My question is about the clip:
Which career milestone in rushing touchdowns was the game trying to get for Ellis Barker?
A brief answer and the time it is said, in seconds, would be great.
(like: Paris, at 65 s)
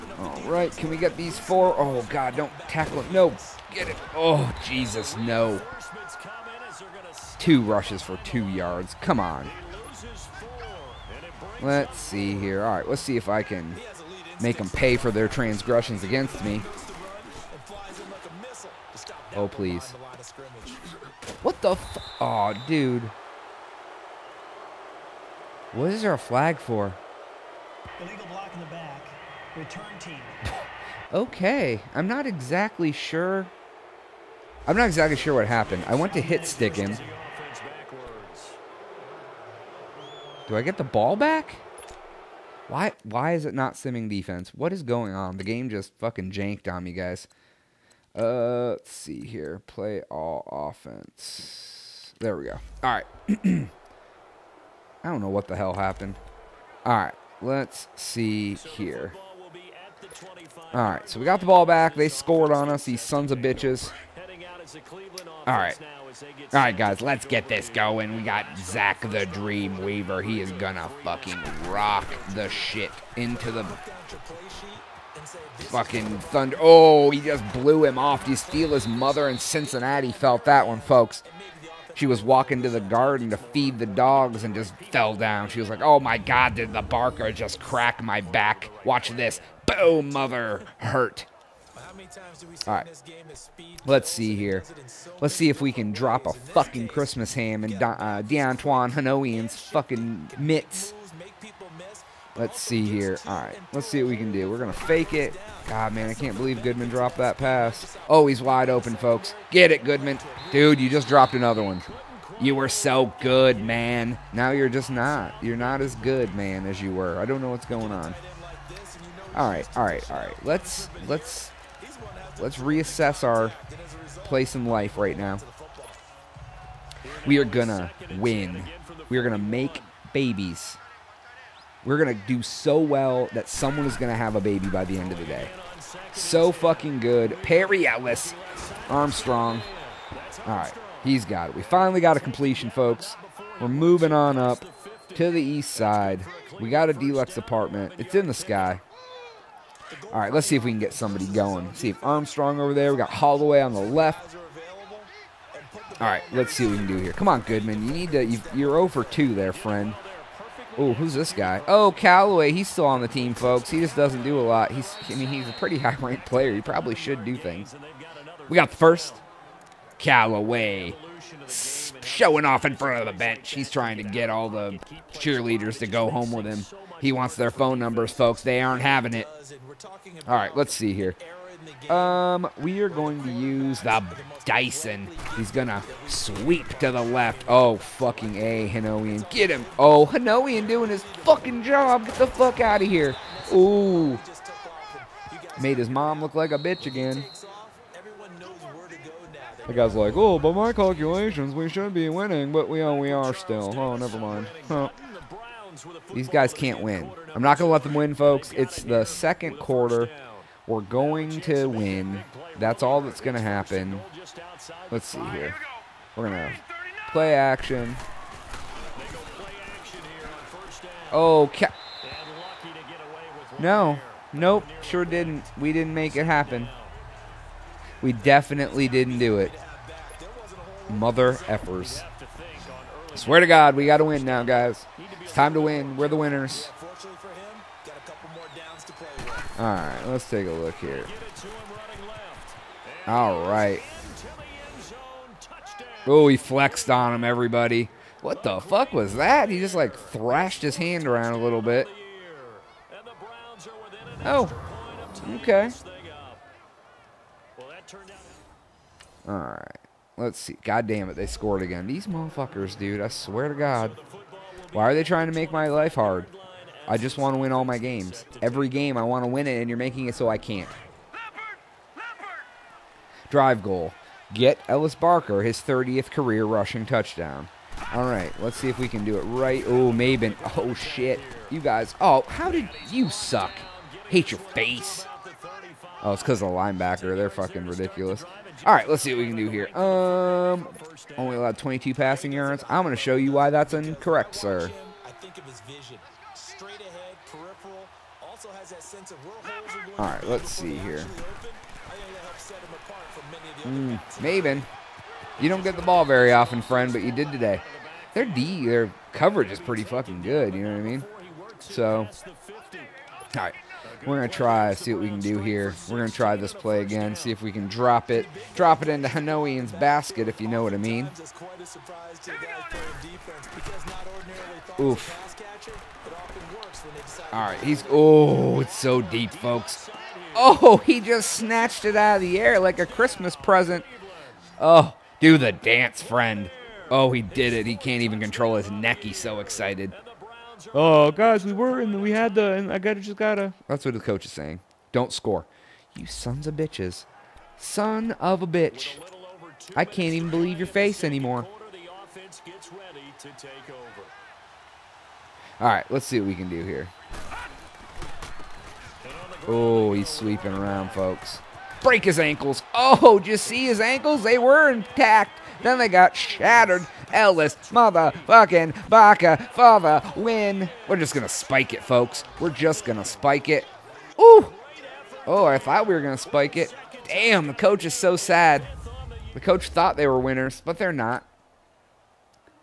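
30th, at 275 s.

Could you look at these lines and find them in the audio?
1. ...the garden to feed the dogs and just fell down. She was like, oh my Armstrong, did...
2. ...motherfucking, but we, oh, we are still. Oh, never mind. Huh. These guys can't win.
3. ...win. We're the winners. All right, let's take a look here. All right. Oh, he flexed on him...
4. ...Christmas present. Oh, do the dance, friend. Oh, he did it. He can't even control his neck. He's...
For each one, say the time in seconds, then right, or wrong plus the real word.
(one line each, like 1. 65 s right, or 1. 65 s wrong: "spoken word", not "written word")
1. 82 s wrong: "God", not "Armstrong"
2. 202 s wrong: "winning", not "motherfucking"
3. 235 s right
4. 332 s right.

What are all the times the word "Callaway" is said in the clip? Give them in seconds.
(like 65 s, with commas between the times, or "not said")
161 s, 169 s.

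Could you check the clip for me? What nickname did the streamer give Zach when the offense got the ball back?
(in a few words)
the Dream Weaver.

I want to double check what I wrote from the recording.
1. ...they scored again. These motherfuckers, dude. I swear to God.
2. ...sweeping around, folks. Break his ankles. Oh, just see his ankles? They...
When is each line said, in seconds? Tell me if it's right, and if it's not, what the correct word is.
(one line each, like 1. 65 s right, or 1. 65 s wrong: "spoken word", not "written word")
1. 261 s right
2. 360 s right.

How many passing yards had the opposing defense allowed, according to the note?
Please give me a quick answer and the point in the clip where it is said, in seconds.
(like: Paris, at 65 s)
22, at 291 s.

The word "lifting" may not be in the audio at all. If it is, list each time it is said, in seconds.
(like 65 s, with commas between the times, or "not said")
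not said.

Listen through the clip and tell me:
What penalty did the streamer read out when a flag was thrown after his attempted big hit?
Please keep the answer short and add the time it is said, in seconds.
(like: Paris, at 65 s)
Illegal Return team, at 28 s.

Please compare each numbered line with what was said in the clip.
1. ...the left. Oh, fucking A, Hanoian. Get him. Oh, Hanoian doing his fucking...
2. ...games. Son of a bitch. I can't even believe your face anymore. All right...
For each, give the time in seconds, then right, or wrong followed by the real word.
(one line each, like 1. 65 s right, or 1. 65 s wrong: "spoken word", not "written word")
1. 186 s right
2. 346 s wrong: "bitches", not "games".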